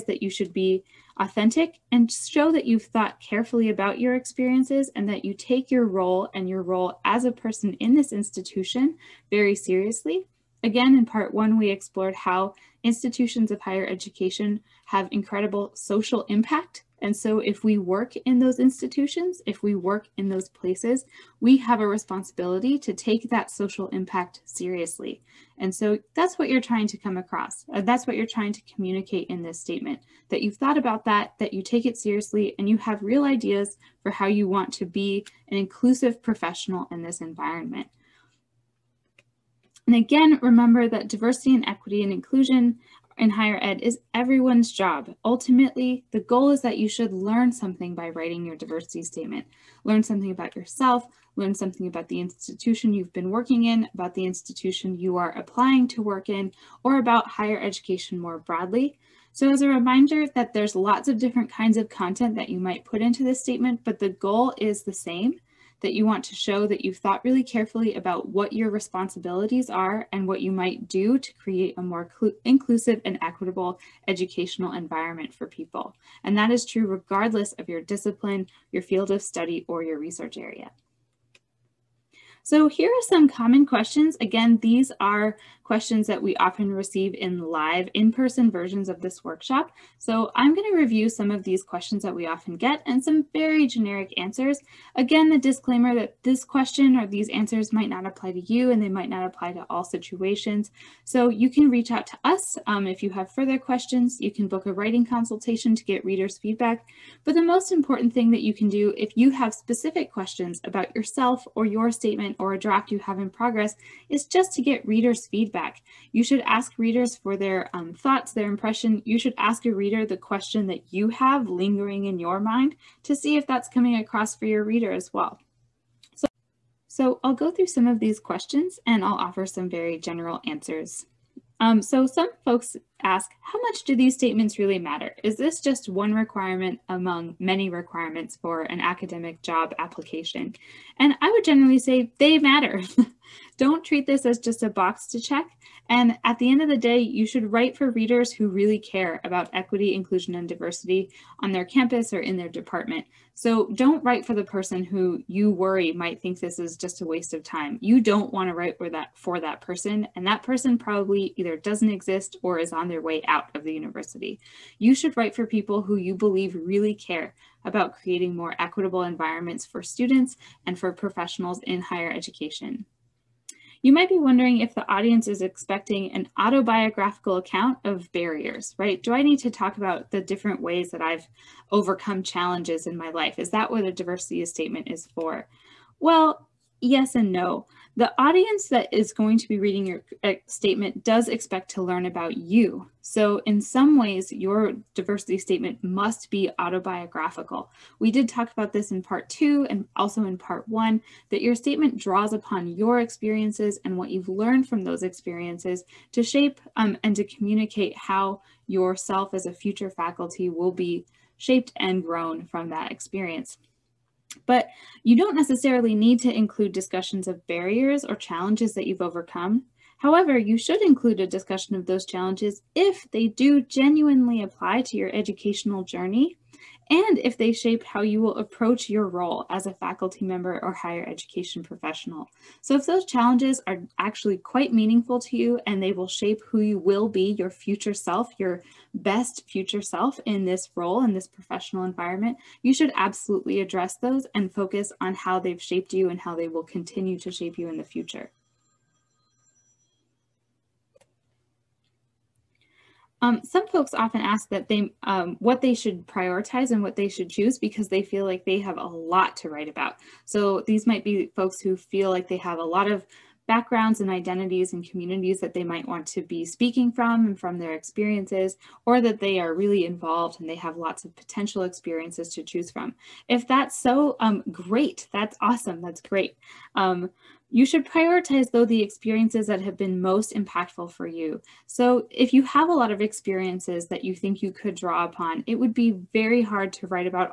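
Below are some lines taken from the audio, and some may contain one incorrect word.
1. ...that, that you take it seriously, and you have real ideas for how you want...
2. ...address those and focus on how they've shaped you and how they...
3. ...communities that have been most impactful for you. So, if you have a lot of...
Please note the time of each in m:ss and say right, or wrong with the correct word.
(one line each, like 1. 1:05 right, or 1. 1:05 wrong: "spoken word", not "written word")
1. 0:31 right
2. 4:03 right
3. 4:38 wrong: "experiences", not "communities".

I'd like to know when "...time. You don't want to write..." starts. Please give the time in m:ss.
2:37.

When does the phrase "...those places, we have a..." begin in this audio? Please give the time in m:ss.
0:20.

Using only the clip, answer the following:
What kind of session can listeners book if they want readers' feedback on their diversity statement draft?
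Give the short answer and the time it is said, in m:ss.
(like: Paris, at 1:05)
Writing consultation, at 1:44.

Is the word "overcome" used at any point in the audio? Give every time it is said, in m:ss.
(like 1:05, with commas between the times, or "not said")
3:01, 3:38.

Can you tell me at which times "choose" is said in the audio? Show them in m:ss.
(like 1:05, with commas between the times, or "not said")
4:17, 4:32.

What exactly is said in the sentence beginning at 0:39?
And again, remember that diversity and equity and inclusion in higher ed is everyone's job.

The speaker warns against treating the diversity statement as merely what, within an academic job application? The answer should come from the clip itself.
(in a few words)
A box to check.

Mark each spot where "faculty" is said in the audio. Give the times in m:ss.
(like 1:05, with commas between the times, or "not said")
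3:29, 3:49.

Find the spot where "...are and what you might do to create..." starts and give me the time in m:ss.
1:09.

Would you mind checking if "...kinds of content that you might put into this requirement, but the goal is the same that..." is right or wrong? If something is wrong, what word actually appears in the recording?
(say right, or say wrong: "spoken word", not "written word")
wrong: "statement", not "requirement".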